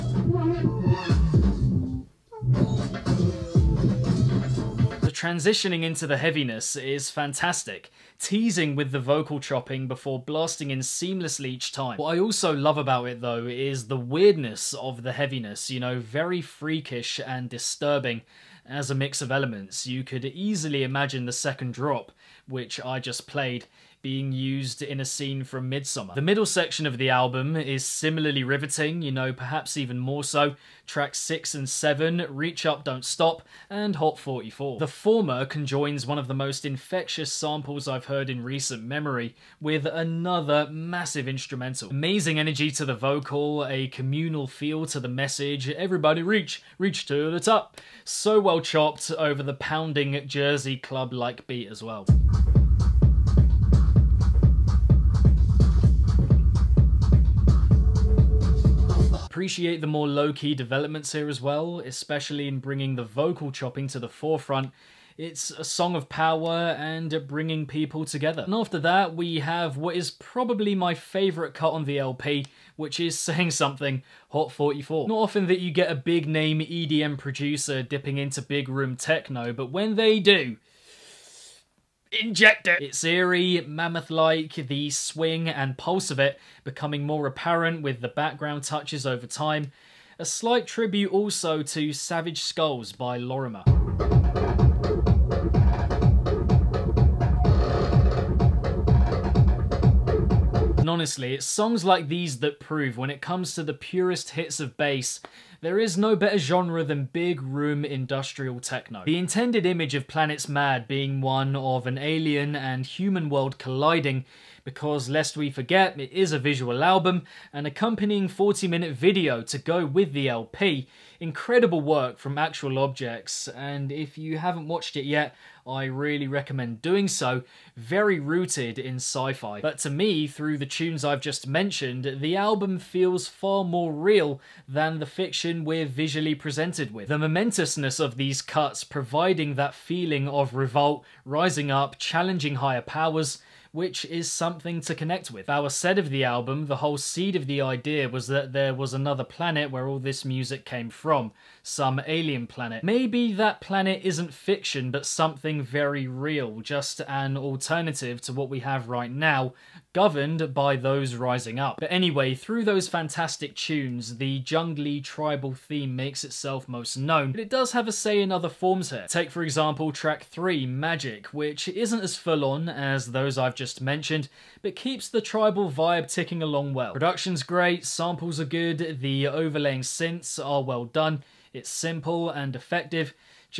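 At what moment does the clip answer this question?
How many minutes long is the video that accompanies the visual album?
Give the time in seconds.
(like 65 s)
118 s.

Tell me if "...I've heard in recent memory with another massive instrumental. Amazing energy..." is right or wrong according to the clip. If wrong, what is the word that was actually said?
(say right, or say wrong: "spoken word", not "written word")
right.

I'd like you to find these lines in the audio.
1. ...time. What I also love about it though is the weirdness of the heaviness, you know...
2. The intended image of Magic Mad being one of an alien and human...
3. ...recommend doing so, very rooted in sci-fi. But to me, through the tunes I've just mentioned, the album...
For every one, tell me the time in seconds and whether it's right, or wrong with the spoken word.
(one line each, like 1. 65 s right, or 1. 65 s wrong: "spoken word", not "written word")
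1. 11 s right
2. 109 s wrong: "Planets", not "Magic"
3. 126 s right.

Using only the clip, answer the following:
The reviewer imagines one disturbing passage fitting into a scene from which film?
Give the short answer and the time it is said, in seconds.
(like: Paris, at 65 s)
Midsommar, at 25 s.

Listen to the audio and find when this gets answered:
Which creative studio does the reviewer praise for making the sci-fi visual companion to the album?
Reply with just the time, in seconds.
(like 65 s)
122 s.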